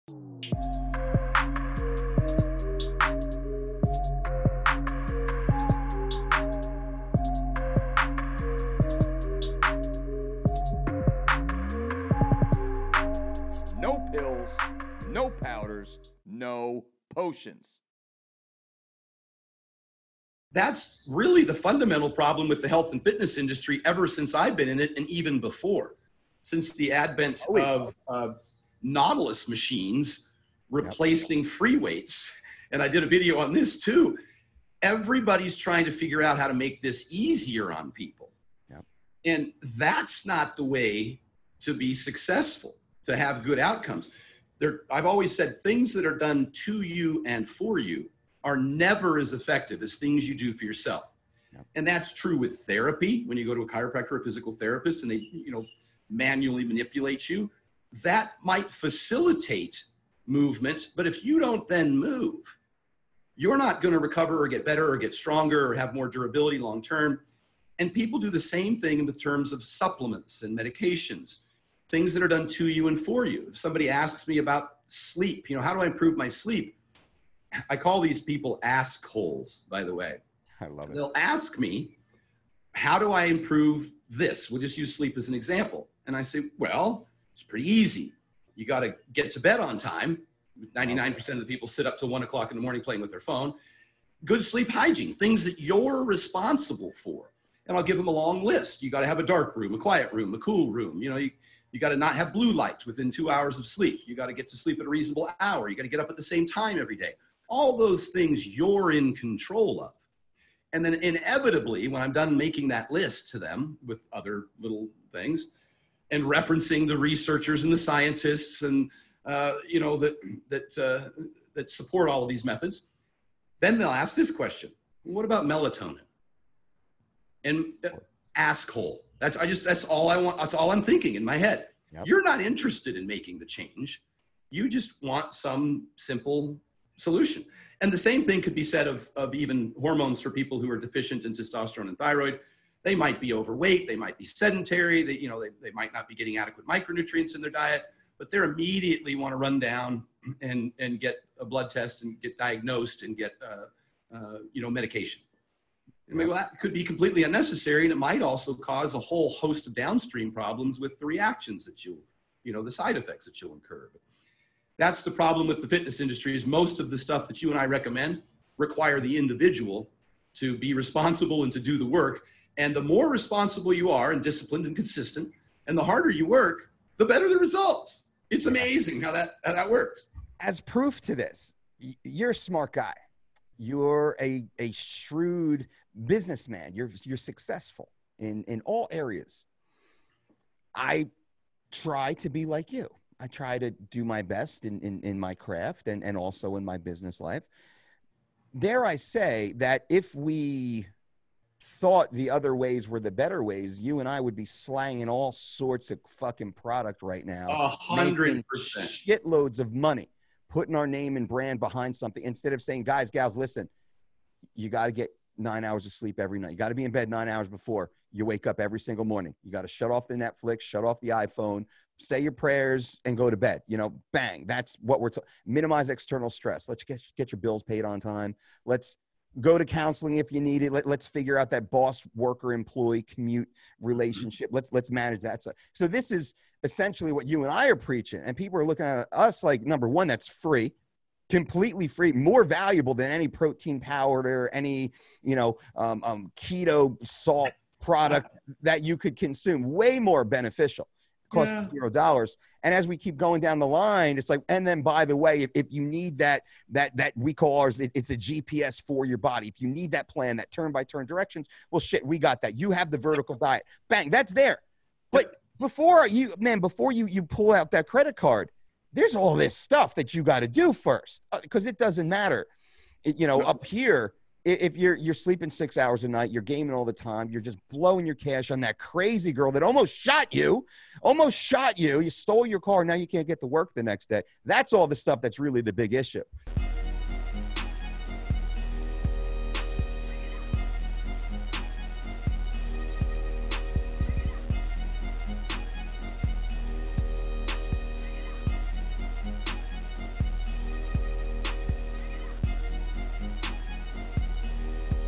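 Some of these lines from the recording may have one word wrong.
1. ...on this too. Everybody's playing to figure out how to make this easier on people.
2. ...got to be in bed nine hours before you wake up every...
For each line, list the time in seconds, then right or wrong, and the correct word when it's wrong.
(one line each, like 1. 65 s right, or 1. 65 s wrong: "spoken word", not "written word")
1. 33 s wrong: "trying", not "playing"
2. 216 s right.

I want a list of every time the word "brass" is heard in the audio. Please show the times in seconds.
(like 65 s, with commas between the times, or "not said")
not said.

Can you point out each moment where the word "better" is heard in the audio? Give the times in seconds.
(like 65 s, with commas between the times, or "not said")
64 s, 177 s, 203 s.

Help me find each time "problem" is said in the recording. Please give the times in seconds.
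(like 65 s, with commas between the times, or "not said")
22 s, 160 s, 165 s.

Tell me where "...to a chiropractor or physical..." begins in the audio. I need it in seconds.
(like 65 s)
53 s.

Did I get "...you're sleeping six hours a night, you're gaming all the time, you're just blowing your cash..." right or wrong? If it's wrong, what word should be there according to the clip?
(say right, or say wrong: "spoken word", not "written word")
right.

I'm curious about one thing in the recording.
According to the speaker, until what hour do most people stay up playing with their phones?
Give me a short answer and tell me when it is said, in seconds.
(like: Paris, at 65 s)
1 o'clock, at 92 s.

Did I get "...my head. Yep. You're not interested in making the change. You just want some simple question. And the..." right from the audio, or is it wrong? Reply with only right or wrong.
wrong.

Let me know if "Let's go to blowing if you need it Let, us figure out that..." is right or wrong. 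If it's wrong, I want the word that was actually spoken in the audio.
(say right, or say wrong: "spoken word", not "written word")
wrong: "counseling", not "blowing".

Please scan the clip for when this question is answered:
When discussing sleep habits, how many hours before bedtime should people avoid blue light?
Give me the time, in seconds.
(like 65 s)
103 s.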